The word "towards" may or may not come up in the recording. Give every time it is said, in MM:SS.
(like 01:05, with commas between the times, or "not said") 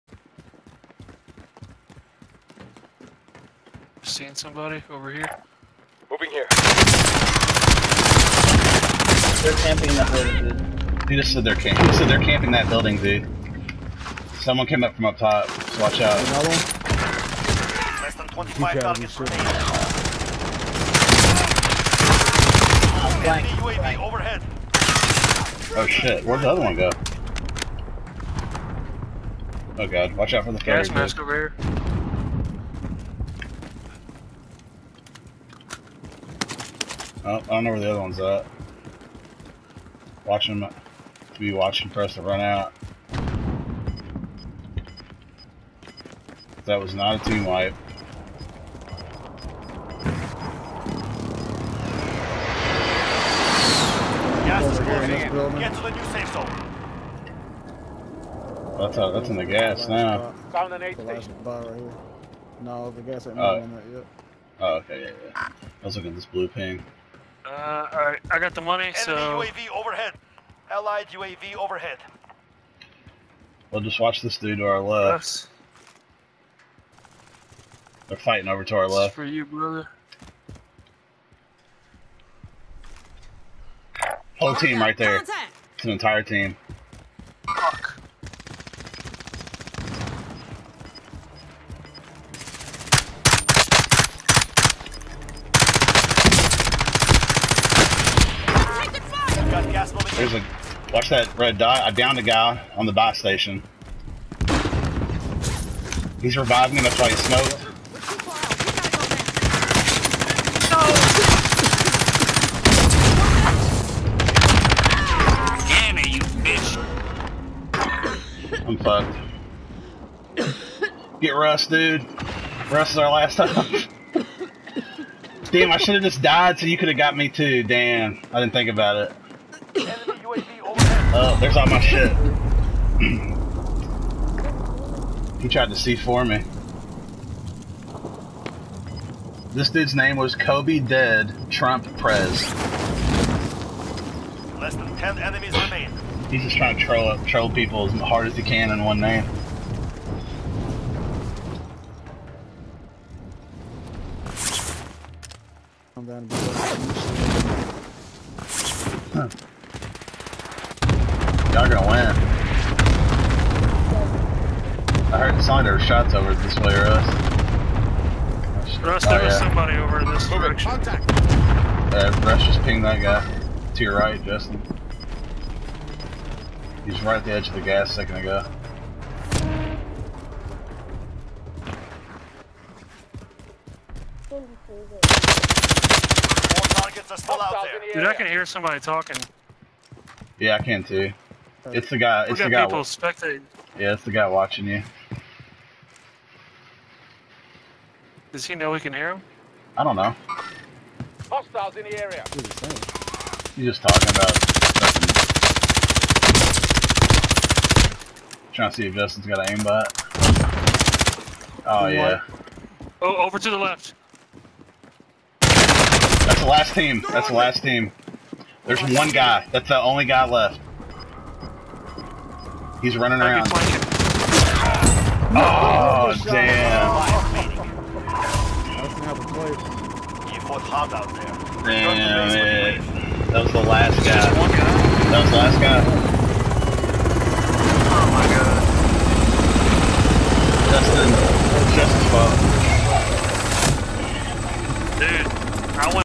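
not said.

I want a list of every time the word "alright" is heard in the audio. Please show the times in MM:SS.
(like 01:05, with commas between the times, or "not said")
01:07.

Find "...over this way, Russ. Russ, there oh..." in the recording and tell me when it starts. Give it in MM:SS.
02:46.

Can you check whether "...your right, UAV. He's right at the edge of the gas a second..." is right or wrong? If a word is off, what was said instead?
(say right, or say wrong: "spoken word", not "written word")
wrong: "Justin", not "UAV".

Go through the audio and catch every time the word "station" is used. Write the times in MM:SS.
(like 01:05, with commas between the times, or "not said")
01:00, 01:43.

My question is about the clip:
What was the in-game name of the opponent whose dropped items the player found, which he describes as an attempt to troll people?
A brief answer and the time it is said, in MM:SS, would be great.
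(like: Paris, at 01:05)
Kobe Dead Trump Prez, at 02:20.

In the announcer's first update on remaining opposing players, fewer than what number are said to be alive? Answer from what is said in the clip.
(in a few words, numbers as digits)
25.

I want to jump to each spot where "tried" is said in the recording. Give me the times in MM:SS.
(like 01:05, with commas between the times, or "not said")
02:15.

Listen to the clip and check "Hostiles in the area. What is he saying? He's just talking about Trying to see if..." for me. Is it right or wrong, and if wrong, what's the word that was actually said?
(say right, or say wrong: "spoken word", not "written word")
right.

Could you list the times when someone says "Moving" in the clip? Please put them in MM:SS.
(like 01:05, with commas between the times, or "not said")
00:06.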